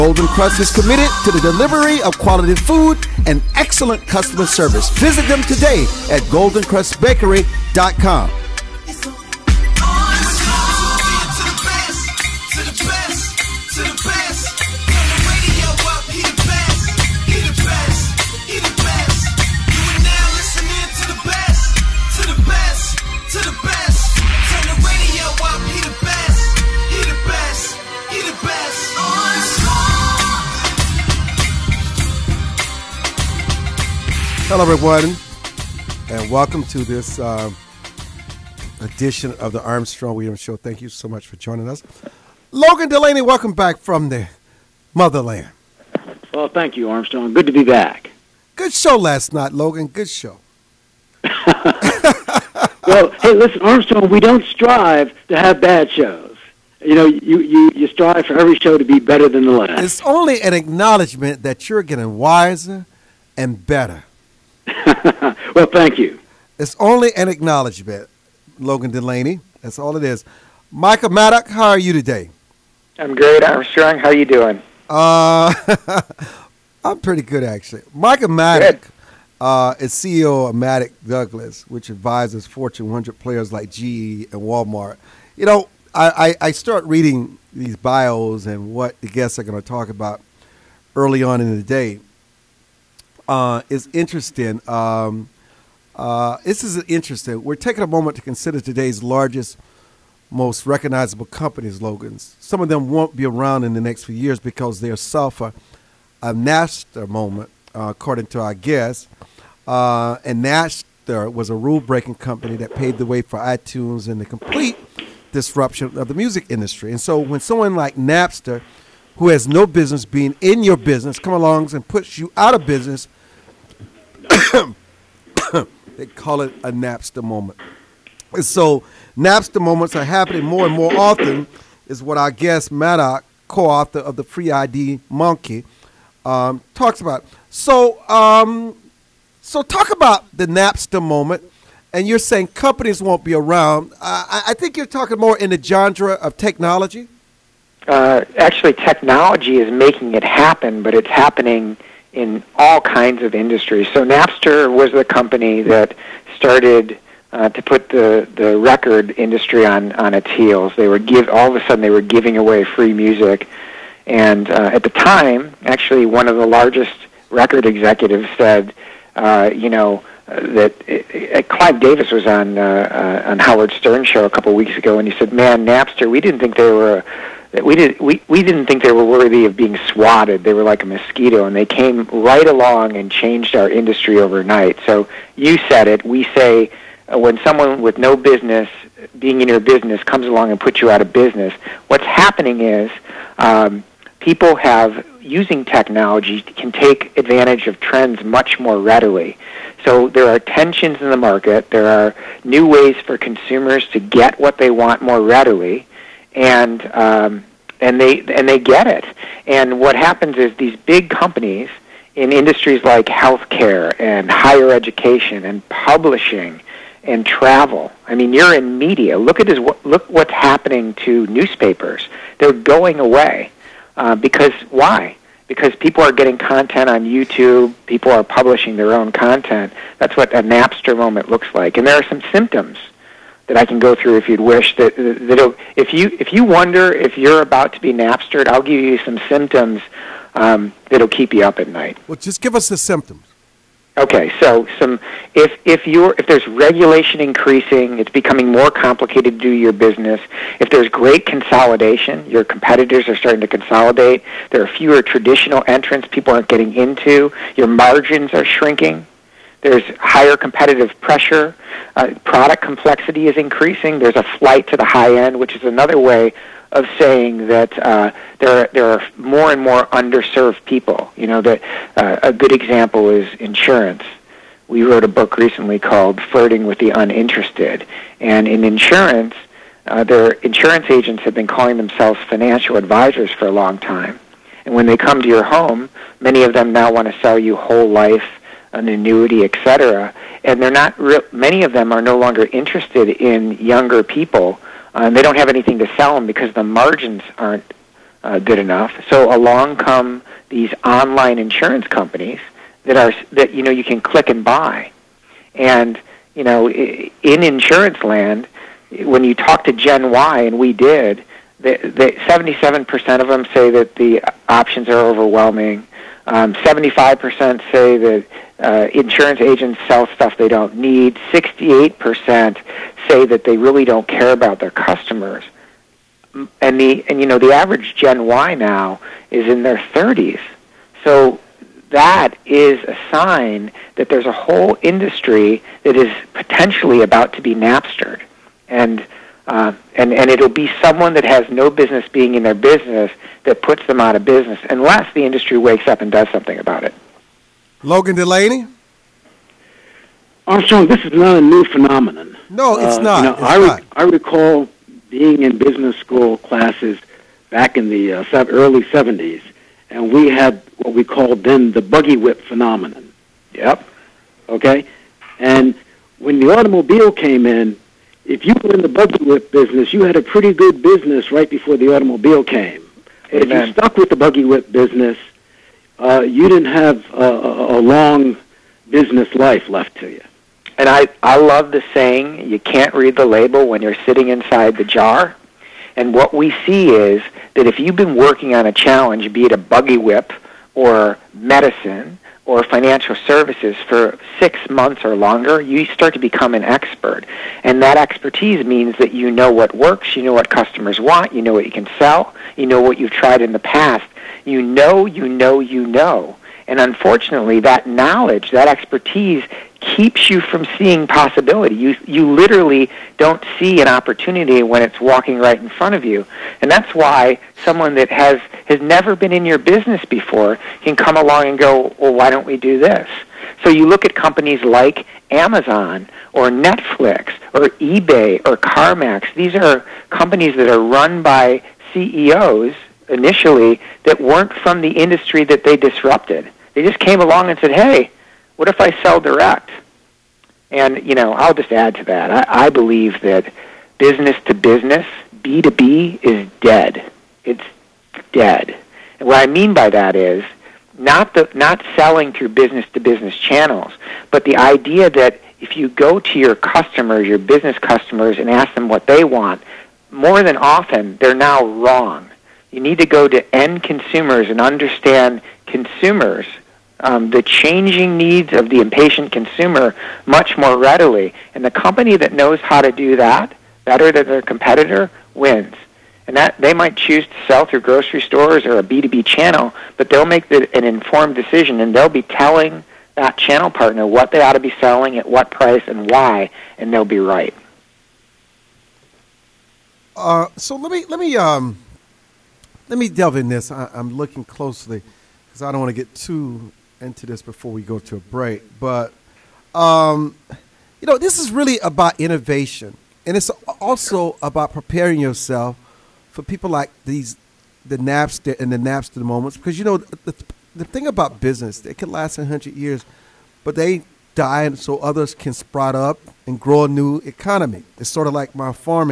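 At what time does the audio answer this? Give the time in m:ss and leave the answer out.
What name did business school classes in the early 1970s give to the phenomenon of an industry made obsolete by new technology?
6:01.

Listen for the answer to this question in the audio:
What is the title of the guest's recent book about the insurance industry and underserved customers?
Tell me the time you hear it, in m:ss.
4:36.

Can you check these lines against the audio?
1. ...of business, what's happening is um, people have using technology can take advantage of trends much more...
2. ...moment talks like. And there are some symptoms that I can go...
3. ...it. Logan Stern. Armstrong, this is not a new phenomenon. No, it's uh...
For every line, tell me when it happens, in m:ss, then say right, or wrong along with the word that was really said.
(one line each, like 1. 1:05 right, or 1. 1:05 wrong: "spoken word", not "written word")
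1. 3:10 right
2. 3:50 wrong: "looks", not "talks"
3. 5:46 wrong: "Delany", not "Stern".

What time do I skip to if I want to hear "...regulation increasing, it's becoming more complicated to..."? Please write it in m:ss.
4:06.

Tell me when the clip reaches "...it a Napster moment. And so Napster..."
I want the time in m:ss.
2:06.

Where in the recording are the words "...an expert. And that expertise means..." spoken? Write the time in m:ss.
6:36.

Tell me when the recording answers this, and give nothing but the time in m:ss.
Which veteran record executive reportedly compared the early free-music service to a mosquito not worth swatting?
2:51.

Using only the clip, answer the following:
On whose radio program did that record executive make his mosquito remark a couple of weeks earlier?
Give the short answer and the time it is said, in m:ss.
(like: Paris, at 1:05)
Howard Stern, at 2:53.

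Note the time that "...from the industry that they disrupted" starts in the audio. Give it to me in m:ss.
7:14.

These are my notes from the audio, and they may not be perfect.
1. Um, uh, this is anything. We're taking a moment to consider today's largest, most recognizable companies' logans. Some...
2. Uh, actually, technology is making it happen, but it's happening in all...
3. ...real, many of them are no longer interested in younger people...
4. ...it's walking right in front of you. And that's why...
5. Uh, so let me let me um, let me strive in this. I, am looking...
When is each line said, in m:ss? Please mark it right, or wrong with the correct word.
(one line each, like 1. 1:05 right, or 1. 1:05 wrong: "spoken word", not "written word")
1. 1:34 wrong: "interesting", not "anything"
2. 2:27 right
3. 4:50 right
4. 6:54 right
5. 8:10 wrong: "delve", not "strive".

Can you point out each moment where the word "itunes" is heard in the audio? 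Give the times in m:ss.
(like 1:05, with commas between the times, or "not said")
1:53.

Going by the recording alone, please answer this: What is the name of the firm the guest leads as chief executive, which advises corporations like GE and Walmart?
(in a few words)
Maddock Douglas.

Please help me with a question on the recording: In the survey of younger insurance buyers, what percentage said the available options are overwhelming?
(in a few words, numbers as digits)
77%.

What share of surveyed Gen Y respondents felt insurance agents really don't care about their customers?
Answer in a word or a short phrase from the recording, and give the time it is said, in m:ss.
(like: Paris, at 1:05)
68%, at 5:21.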